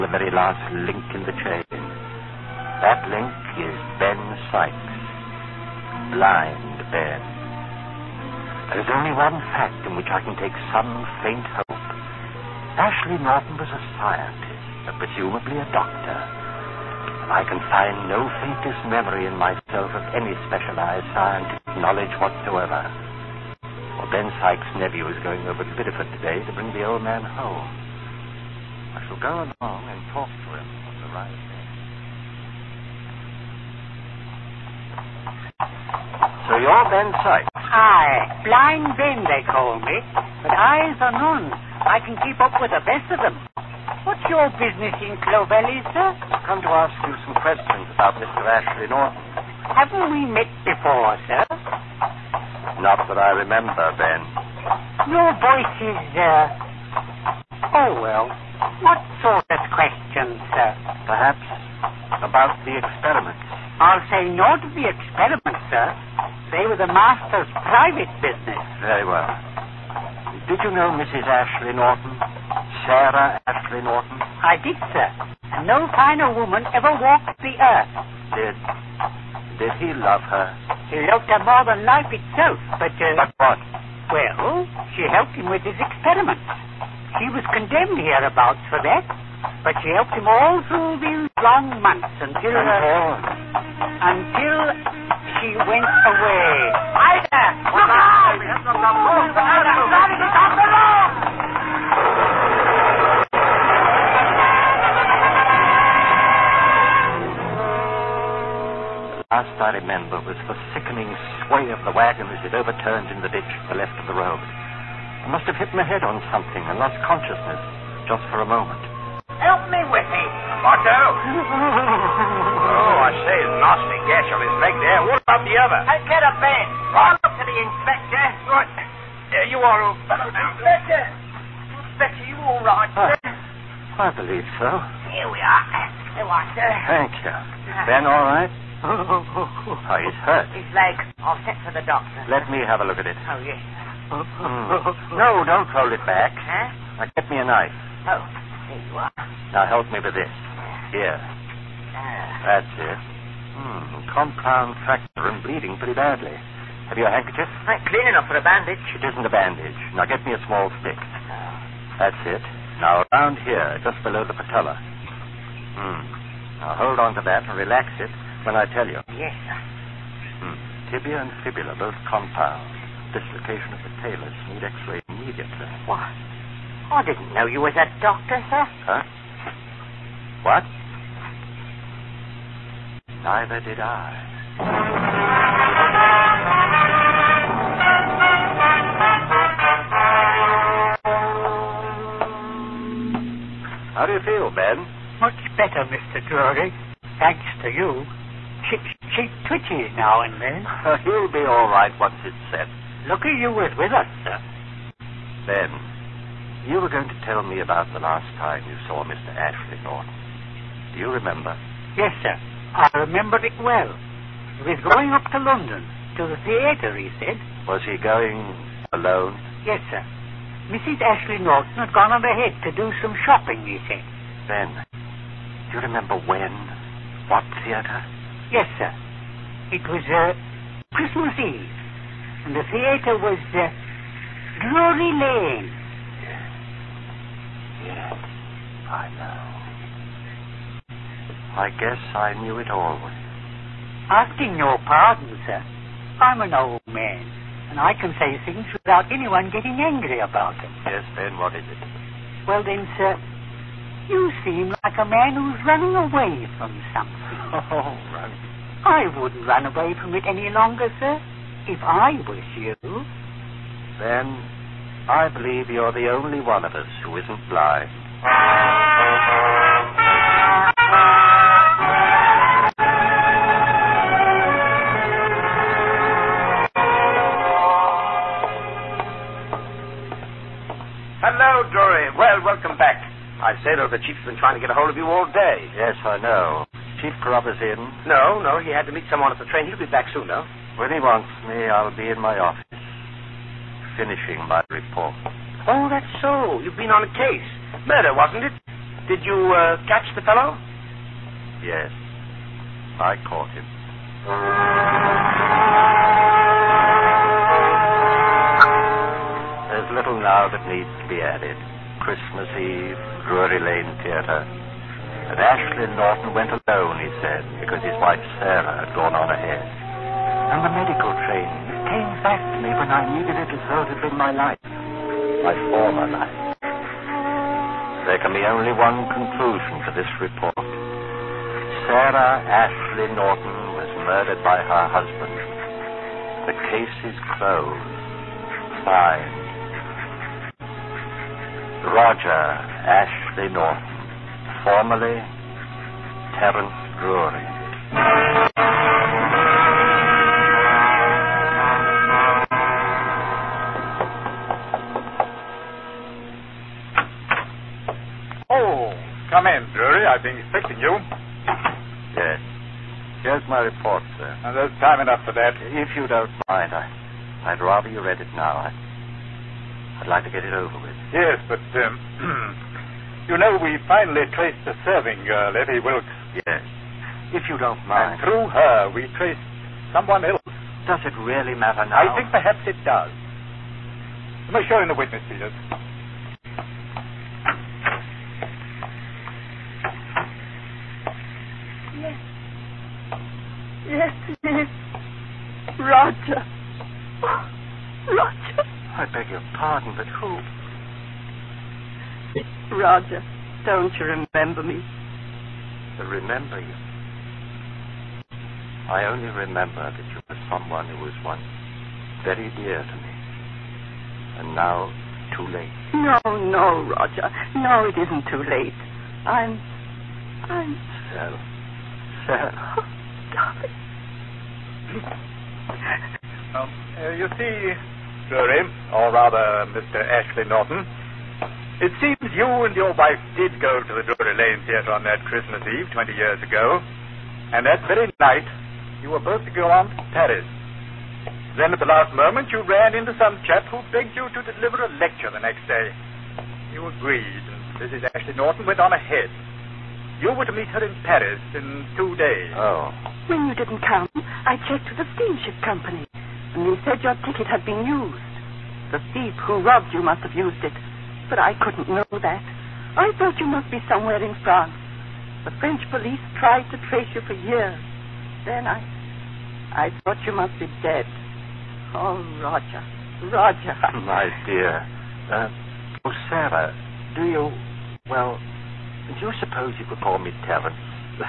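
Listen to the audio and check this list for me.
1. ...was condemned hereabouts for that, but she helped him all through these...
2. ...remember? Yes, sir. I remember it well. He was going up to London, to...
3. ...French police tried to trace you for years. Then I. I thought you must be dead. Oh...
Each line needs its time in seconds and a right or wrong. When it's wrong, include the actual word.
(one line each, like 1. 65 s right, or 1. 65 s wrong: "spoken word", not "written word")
1. 87 s right
2. 211 s right
3. 465 s right.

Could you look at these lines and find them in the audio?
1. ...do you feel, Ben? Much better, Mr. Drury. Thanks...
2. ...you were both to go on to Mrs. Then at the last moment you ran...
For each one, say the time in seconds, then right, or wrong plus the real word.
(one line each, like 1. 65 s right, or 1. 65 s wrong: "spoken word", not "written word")
1. 194 s right
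2. 439 s wrong: "Paris", not "Mrs".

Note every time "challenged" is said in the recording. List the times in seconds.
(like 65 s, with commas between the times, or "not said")
not said.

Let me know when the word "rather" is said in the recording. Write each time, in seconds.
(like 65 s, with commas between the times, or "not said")
367 s, 429 s.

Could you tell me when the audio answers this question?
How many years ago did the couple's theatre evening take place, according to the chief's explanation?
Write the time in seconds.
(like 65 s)
435 s.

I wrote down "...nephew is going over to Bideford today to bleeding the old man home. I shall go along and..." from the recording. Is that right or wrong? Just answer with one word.
wrong.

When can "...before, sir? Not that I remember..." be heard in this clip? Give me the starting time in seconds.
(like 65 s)
50 s.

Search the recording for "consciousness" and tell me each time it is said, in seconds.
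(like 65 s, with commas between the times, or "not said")
117 s.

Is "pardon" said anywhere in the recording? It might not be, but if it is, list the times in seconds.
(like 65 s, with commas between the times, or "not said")
244 s, 399 s.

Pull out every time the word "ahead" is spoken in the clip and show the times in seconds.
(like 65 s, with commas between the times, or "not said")
222 s, 319 s, 448 s.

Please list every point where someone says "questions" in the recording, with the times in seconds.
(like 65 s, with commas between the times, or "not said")
47 s, 59 s.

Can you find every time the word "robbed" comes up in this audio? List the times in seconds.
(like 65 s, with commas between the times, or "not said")
459 s.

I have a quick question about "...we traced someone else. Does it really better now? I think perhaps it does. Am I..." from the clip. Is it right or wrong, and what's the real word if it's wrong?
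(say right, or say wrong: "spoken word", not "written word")
wrong: "matter", not "better".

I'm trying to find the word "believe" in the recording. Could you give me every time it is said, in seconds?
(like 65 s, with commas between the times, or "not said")
134 s, 265 s.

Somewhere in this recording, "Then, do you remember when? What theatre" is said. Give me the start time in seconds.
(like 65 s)
224 s.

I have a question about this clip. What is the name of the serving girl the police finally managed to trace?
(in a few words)
Effie Wilkes.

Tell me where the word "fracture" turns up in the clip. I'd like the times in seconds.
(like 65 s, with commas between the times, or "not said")
154 s.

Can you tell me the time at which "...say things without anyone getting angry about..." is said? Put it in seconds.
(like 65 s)
248 s.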